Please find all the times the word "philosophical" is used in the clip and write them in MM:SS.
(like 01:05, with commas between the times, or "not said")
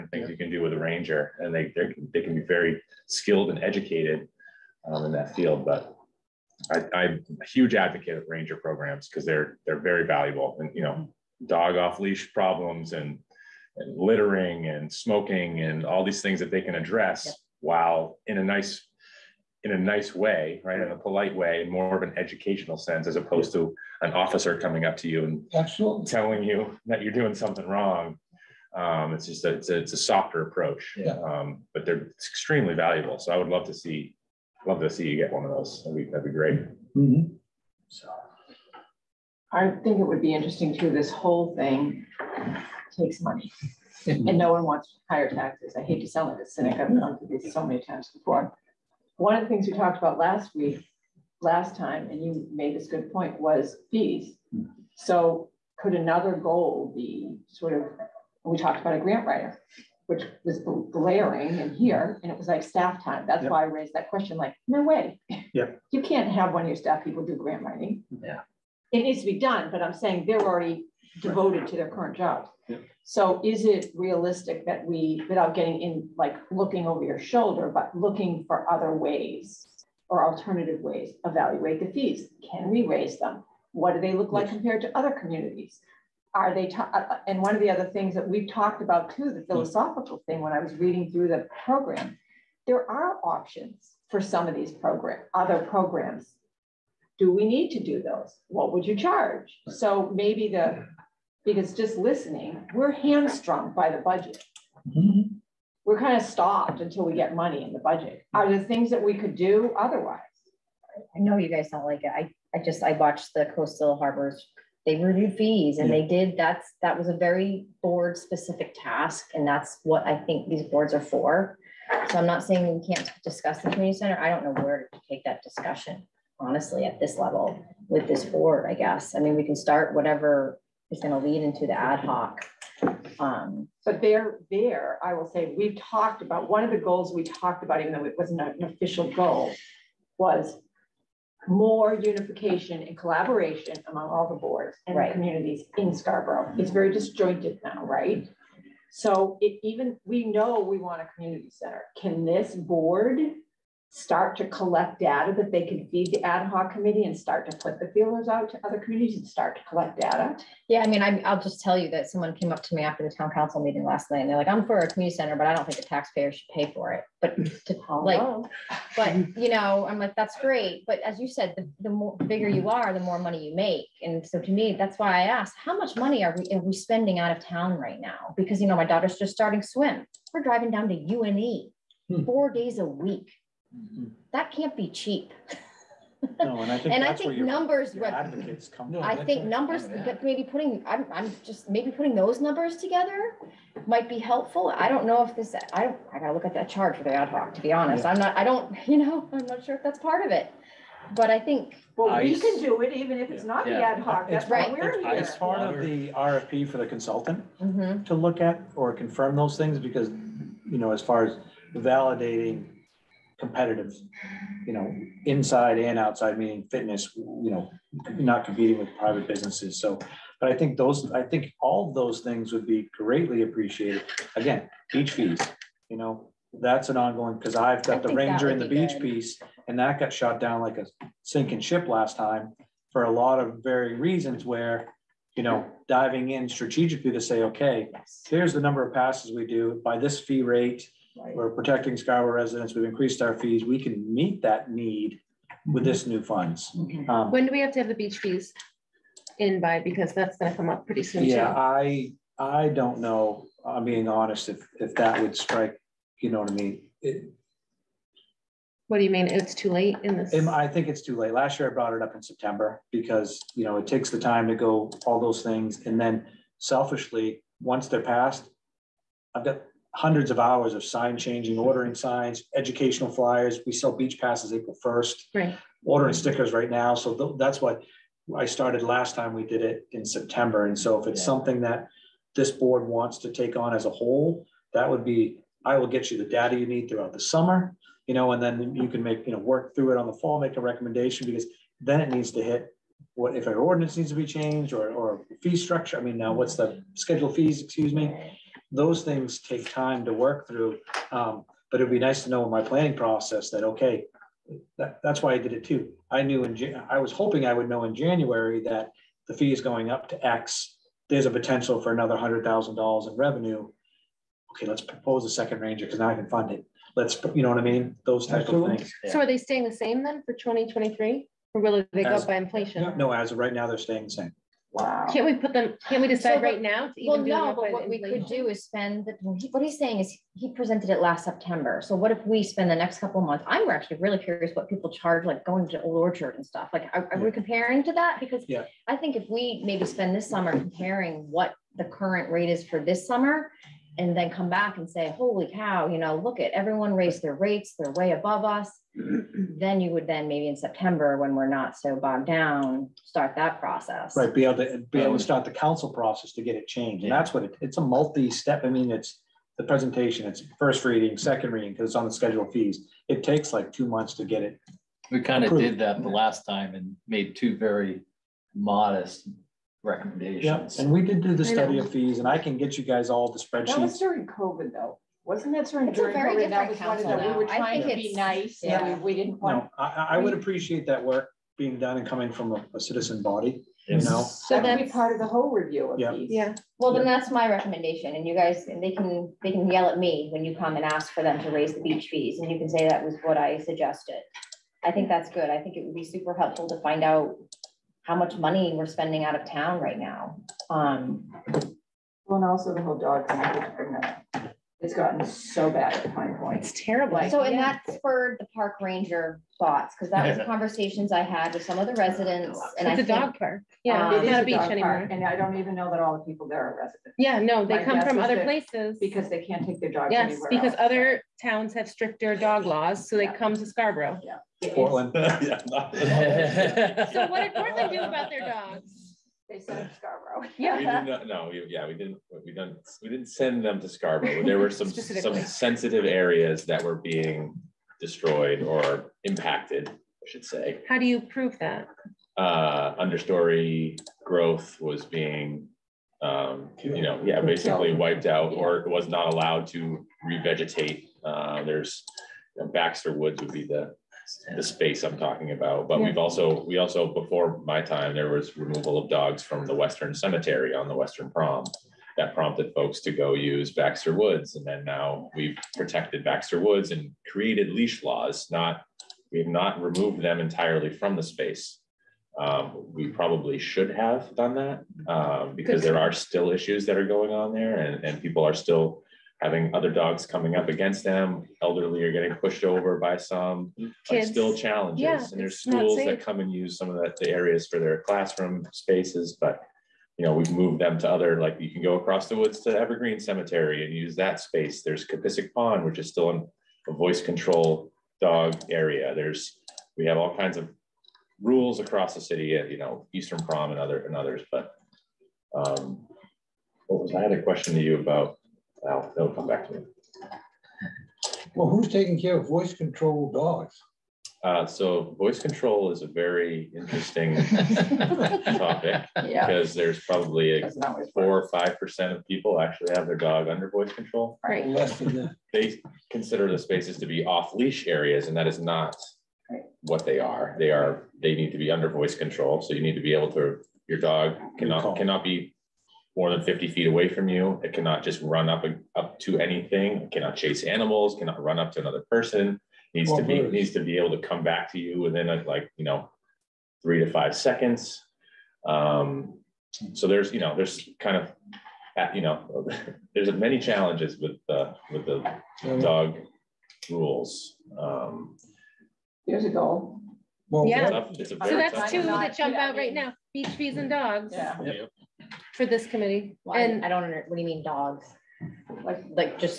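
01:29.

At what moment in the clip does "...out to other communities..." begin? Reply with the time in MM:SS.
02:38.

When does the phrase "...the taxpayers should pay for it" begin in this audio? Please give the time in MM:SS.
02:45.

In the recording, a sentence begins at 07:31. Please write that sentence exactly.
Uh, there's you know, Baxter Woods would be the the space I'm talking about.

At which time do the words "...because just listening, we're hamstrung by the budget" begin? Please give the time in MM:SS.
01:41.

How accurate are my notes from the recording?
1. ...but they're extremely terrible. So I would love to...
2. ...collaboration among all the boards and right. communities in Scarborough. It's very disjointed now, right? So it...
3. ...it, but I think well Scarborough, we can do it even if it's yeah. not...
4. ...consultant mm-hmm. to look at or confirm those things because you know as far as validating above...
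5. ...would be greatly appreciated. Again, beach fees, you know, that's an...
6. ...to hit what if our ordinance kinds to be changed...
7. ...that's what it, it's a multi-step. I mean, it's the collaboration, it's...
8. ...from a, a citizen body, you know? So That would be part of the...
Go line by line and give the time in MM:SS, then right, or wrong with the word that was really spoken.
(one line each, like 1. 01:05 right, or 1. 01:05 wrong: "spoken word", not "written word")
1. 00:31 wrong: "valuable", not "terrible"
2. 02:22 right
3. 03:20 wrong: "ICE", not "Scarborough"
4. 03:26 wrong: "competitive", not "above"
5. 03:42 right
6. 04:52 wrong: "needs", not "kinds"
7. 05:57 wrong: "presentation", not "collaboration"
8. 06:22 right.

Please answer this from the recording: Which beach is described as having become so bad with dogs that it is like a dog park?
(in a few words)
Pine Point.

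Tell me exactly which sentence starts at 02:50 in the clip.
But as you said, the, the more bigger you are, the more money you make.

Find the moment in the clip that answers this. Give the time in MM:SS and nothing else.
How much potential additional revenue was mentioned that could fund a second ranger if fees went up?
05:12.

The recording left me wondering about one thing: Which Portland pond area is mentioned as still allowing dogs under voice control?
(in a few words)
Capisic Pond.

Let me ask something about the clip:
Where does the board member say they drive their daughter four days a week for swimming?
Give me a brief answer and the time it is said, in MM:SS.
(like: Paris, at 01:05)
UNE, at 03:00.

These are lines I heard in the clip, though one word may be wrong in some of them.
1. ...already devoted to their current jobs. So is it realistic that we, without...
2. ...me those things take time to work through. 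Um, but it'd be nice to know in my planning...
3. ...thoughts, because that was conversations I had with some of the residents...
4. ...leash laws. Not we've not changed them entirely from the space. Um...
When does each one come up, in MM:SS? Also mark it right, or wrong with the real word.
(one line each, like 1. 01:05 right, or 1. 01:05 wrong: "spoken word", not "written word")
1. 01:10 right
2. 04:57 right
3. 06:49 right
4. 07:47 wrong: "removed", not "changed".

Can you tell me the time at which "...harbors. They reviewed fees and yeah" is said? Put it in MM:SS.
01:53.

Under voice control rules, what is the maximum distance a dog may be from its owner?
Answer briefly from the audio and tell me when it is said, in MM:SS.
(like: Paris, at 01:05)
50 feet, at 08:56.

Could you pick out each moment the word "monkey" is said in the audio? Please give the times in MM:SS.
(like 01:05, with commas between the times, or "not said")
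not said.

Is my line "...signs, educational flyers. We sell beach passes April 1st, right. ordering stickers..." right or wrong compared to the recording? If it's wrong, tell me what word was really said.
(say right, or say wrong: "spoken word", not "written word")
right.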